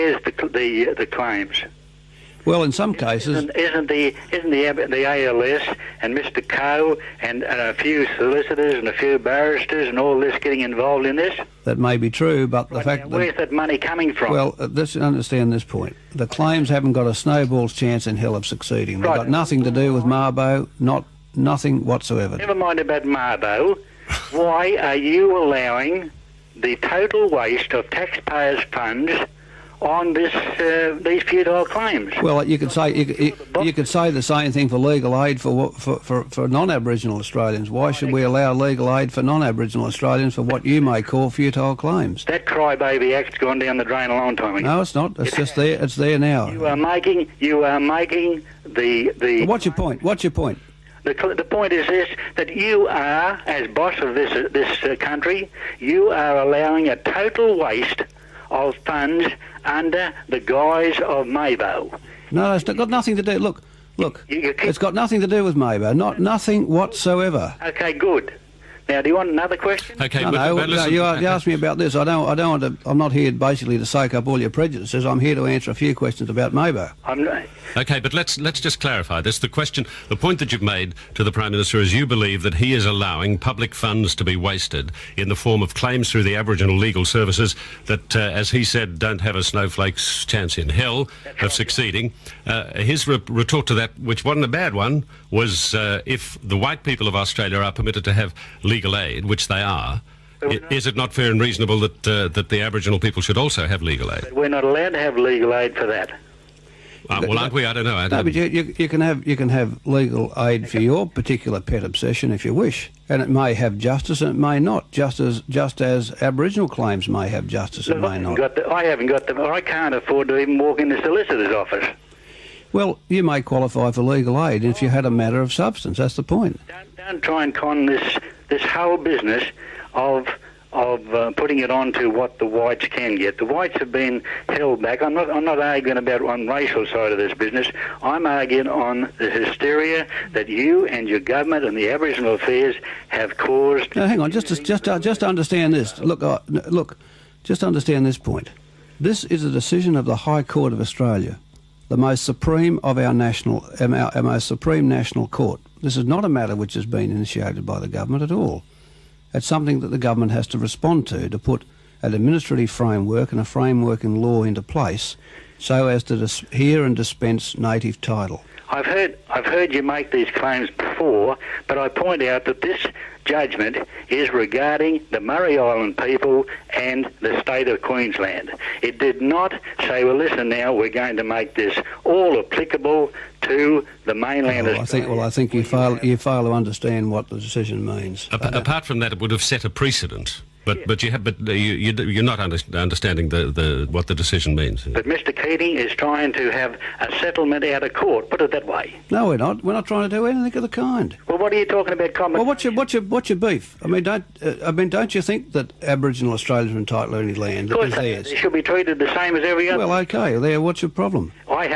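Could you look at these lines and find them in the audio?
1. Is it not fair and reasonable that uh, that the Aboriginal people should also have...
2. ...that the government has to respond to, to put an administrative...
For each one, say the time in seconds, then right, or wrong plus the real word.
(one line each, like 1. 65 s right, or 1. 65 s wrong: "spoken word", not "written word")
1. 100 s right
2. 159 s right.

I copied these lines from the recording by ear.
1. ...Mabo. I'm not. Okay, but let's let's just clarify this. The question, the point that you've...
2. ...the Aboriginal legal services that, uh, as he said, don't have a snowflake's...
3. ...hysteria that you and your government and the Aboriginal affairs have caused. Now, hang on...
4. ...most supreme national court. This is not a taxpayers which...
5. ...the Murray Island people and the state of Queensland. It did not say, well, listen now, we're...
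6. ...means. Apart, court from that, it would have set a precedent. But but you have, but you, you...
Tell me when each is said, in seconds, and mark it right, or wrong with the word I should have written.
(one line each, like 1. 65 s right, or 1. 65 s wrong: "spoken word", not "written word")
1. 76 s right
2. 86 s right
3. 139 s right
4. 154 s wrong: "matter", not "taxpayers"
5. 175 s right
6. 187 s wrong: "apart", not "court".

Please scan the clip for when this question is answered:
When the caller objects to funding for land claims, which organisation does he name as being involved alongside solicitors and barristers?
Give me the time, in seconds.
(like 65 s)
5 s.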